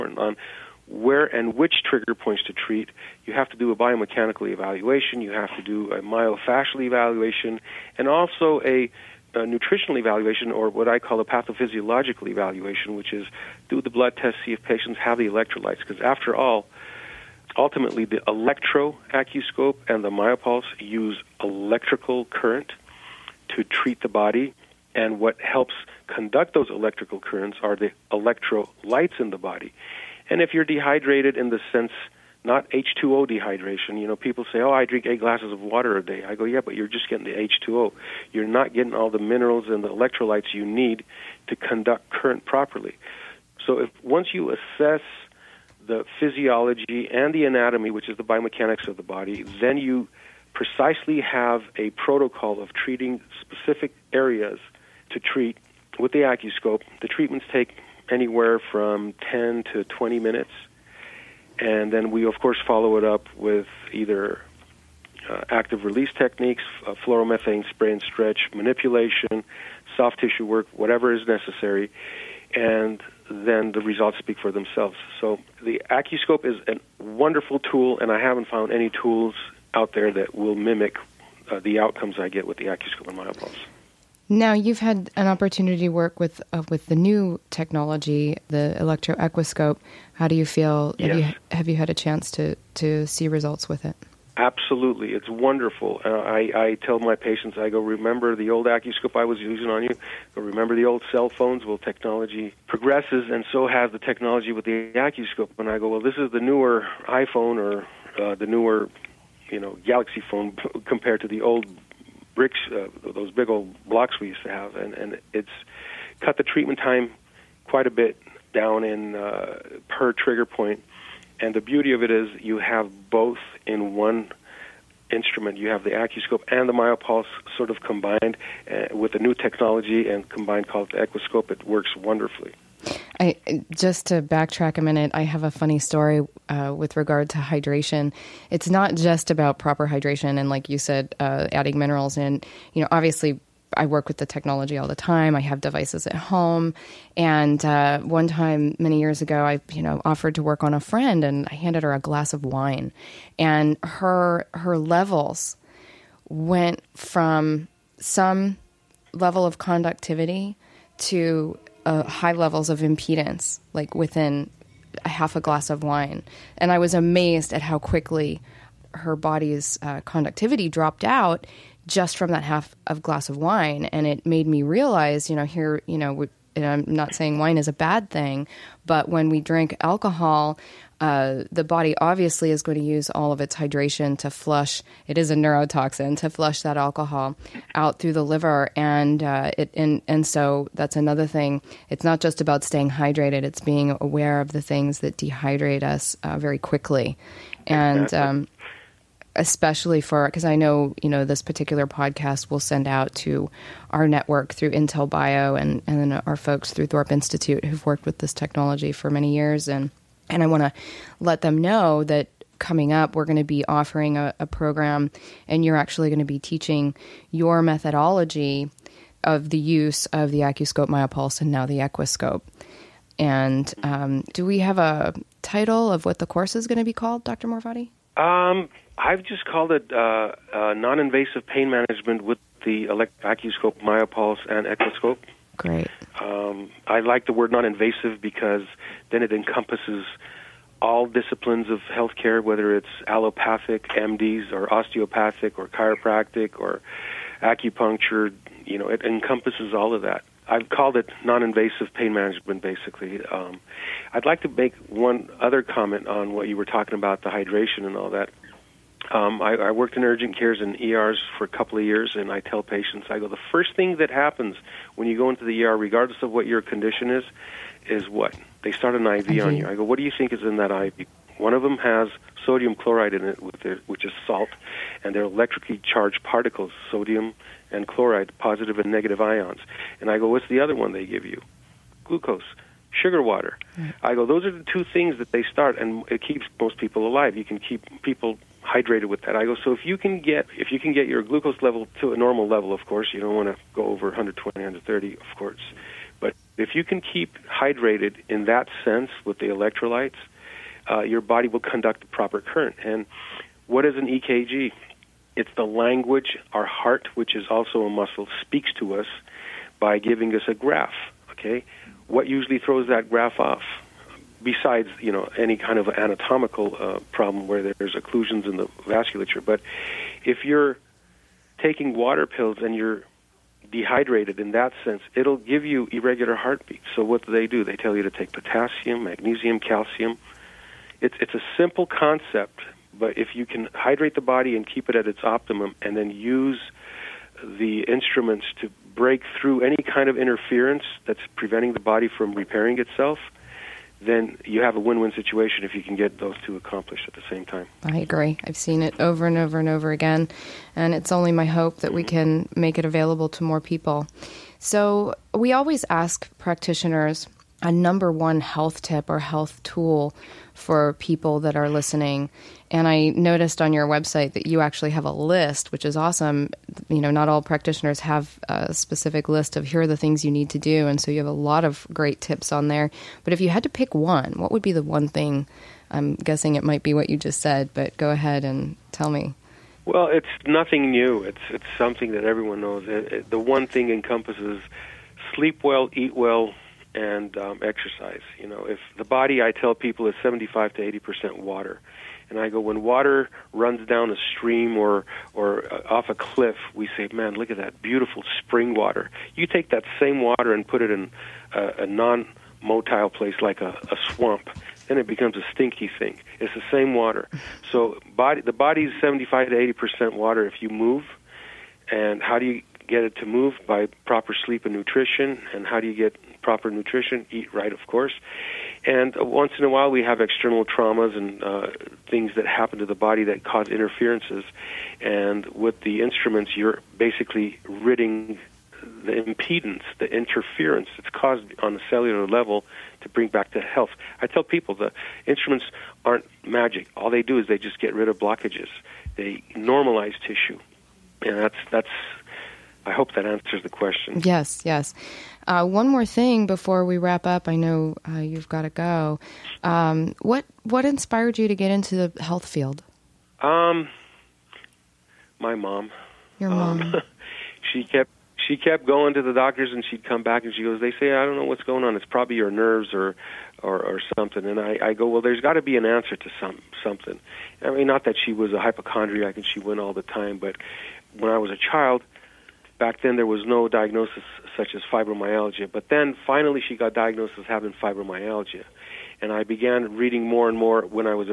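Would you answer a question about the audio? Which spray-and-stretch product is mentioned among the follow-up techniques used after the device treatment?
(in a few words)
fluoromethane spray.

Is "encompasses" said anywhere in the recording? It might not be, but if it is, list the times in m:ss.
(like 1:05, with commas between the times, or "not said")
3:59, 4:09, 6:23.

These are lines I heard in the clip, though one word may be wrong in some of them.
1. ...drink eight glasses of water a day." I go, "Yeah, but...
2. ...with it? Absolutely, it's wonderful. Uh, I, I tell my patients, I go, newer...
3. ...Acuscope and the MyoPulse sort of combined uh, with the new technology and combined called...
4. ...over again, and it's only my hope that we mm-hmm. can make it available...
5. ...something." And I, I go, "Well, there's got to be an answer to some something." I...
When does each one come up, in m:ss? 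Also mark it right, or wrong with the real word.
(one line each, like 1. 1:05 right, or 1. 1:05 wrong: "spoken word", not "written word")
1. 0:34 right
2. 1:33 wrong: "remember", not "newer"
3. 2:05 right
4. 5:49 right
5. 7:44 right.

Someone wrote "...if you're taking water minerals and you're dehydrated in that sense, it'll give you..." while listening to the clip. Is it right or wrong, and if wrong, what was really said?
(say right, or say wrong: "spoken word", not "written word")
wrong: "pills", not "minerals".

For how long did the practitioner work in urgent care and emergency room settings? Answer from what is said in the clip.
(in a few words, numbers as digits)
a couple of years.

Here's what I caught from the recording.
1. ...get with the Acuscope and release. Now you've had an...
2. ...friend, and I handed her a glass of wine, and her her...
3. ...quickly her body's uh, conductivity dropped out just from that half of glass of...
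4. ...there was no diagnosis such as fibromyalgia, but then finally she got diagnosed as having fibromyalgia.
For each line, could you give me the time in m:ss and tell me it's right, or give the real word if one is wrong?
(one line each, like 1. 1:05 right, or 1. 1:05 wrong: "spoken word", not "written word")
1. 1:22 wrong: "myopulse", not "release"
2. 2:30 right
3. 2:47 right
4. 7:53 right.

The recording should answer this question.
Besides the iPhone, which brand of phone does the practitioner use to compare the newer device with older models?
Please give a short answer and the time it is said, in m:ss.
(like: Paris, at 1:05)
Galaxy, at 1:49.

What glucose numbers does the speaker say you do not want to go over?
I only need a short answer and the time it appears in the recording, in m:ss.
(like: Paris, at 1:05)
120, 130, at 4:54.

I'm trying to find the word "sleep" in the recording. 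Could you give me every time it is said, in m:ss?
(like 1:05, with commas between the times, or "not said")
6:25, 6:54.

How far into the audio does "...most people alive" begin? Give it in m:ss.
4:46.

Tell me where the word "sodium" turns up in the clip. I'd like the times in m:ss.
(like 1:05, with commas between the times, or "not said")
4:32, 4:36.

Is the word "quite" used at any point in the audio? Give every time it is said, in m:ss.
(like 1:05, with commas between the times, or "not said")
1:57.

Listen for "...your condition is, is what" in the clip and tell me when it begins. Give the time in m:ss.
4:26.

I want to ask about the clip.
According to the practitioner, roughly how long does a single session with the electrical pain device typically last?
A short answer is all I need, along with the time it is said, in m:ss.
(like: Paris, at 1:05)
10 to 20 minutes, at 0:59.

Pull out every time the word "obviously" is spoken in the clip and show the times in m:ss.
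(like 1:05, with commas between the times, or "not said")
2:22, 3:01.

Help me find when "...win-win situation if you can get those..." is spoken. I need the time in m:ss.
5:44.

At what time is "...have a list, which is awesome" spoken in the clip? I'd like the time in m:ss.
6:04.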